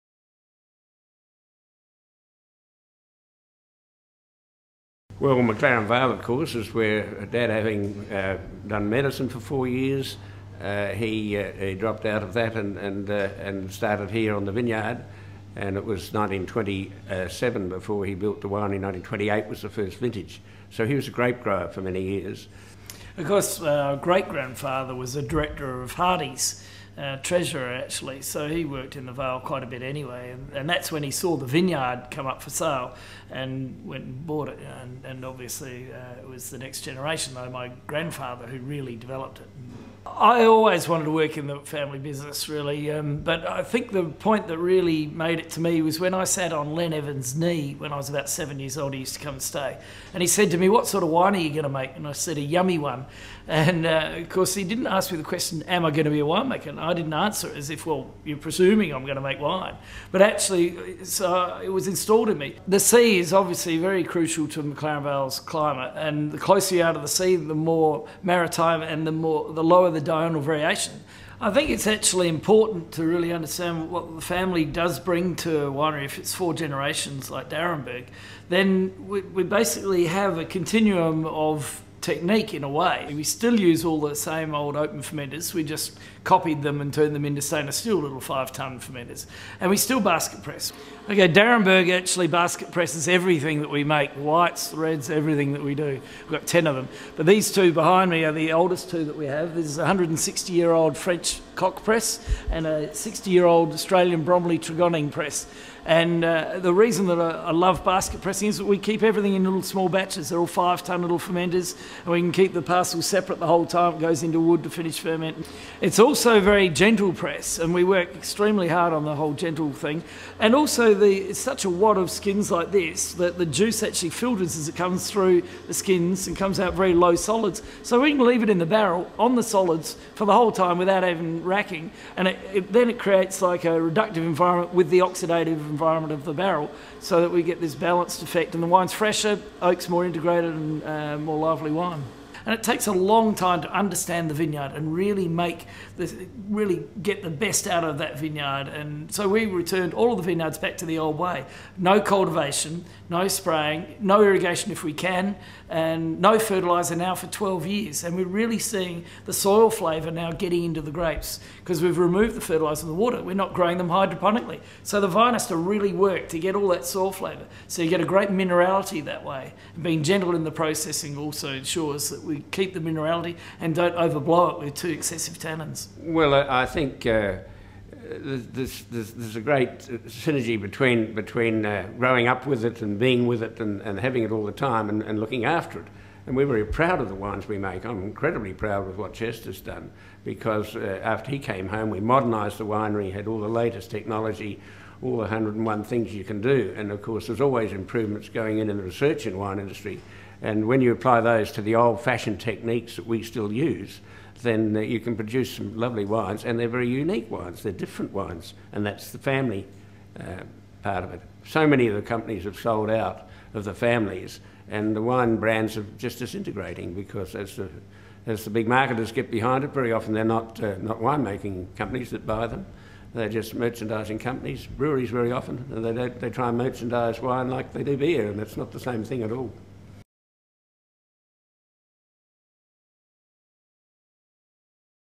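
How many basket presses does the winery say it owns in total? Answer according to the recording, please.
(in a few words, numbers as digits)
10.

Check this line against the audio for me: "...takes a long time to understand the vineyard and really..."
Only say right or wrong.
right.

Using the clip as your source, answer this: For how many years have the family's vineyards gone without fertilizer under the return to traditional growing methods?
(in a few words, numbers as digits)
12 years.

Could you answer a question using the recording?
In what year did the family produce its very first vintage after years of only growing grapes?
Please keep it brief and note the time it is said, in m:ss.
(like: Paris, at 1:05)
1928, at 0:18.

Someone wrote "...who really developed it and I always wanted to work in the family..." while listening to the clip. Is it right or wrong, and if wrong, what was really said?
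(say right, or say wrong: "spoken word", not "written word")
right.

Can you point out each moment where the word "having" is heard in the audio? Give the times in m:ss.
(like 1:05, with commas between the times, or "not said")
0:07, 3:03.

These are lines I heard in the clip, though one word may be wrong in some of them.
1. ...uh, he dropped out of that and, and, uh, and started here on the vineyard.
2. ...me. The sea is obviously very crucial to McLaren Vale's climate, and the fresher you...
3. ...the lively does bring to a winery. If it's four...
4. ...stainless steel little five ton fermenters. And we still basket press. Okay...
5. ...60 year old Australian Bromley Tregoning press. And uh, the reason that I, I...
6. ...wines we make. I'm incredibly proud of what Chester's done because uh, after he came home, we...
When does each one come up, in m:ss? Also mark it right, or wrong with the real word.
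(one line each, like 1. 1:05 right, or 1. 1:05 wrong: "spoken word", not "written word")
1. 0:11 right
2. 1:02 wrong: "closer", not "fresher"
3. 1:14 wrong: "family", not "lively"
4. 1:27 right
5. 1:42 right
6. 3:07 right.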